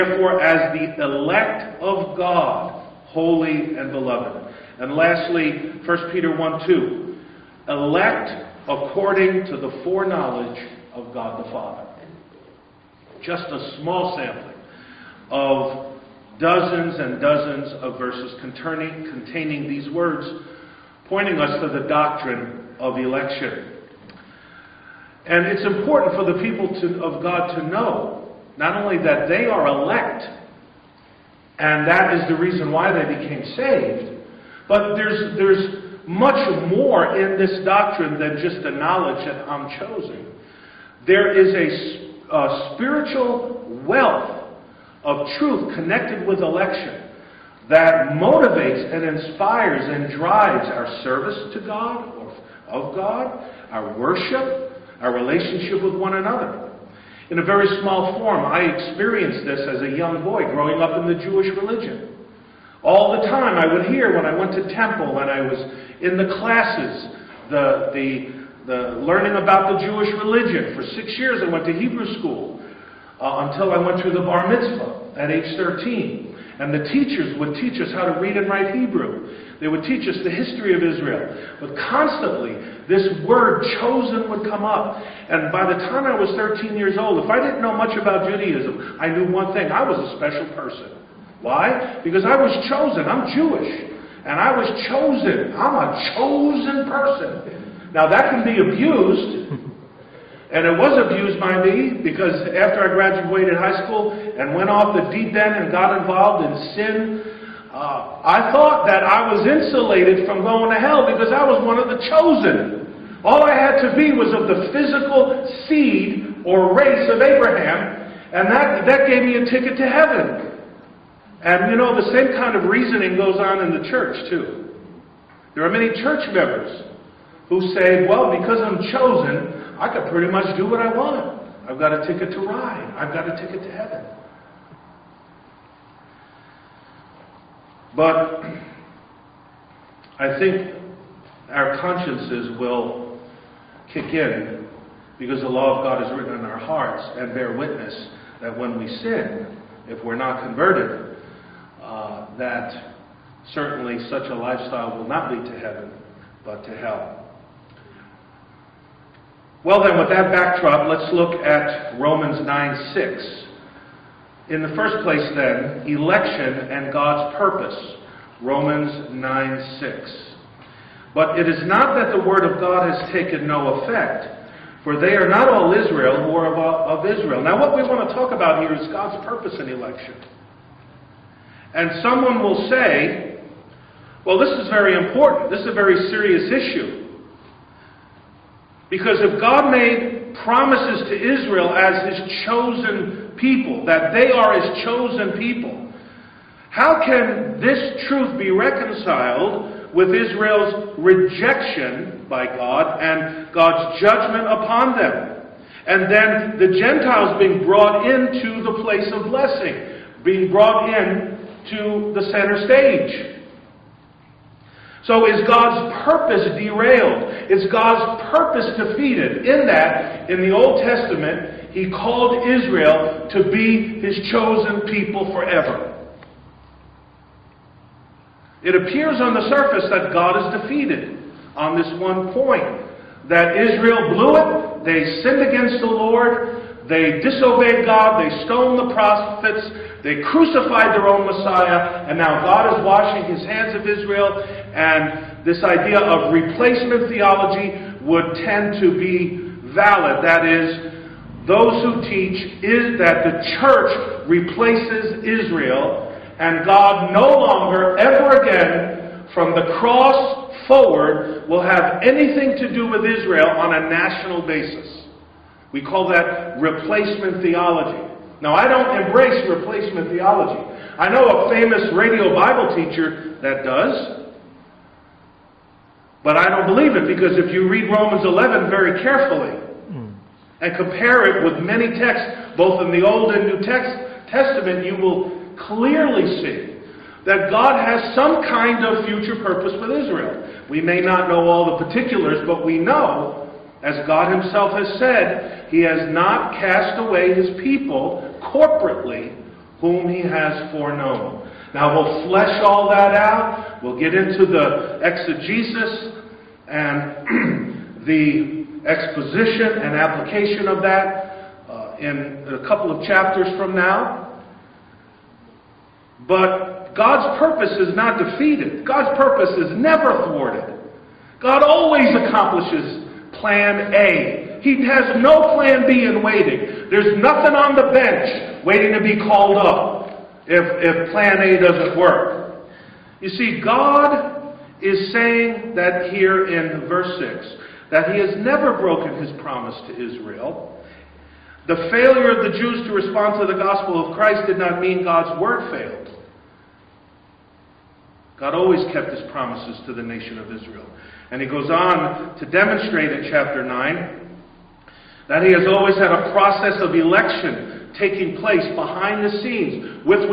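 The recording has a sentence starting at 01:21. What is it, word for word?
But constantly, this word chosen would come up.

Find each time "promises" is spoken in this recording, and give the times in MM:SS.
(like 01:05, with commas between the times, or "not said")
03:10, 05:39, 05:49.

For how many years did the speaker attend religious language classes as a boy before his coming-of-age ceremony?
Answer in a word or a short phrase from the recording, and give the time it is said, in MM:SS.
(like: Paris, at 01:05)
6, at 01:10.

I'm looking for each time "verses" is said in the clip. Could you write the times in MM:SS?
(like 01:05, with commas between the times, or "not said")
00:17, 05:36.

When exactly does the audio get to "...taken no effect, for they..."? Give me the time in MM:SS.
02:53.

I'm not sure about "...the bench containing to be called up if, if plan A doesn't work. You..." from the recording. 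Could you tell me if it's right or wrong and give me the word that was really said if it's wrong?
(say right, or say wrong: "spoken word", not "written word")
wrong: "waiting", not "containing".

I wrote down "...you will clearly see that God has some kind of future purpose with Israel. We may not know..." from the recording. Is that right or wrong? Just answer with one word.
right.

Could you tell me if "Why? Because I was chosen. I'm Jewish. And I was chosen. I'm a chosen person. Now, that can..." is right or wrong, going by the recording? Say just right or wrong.
right.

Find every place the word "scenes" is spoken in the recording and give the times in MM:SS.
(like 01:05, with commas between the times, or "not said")
05:59.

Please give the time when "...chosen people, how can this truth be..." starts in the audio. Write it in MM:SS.
03:14.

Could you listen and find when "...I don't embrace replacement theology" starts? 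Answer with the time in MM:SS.
04:28.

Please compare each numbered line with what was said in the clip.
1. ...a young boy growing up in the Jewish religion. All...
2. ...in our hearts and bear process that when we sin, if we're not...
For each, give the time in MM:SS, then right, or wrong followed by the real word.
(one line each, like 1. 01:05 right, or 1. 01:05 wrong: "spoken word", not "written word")
1. 00:59 right
2. 02:26 wrong: "witness", not "process".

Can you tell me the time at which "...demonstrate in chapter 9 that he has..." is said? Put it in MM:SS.
05:52.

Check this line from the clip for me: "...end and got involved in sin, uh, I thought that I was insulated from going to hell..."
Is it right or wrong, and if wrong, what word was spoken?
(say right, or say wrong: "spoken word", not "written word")
right.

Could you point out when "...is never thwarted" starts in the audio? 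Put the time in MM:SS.
05:19.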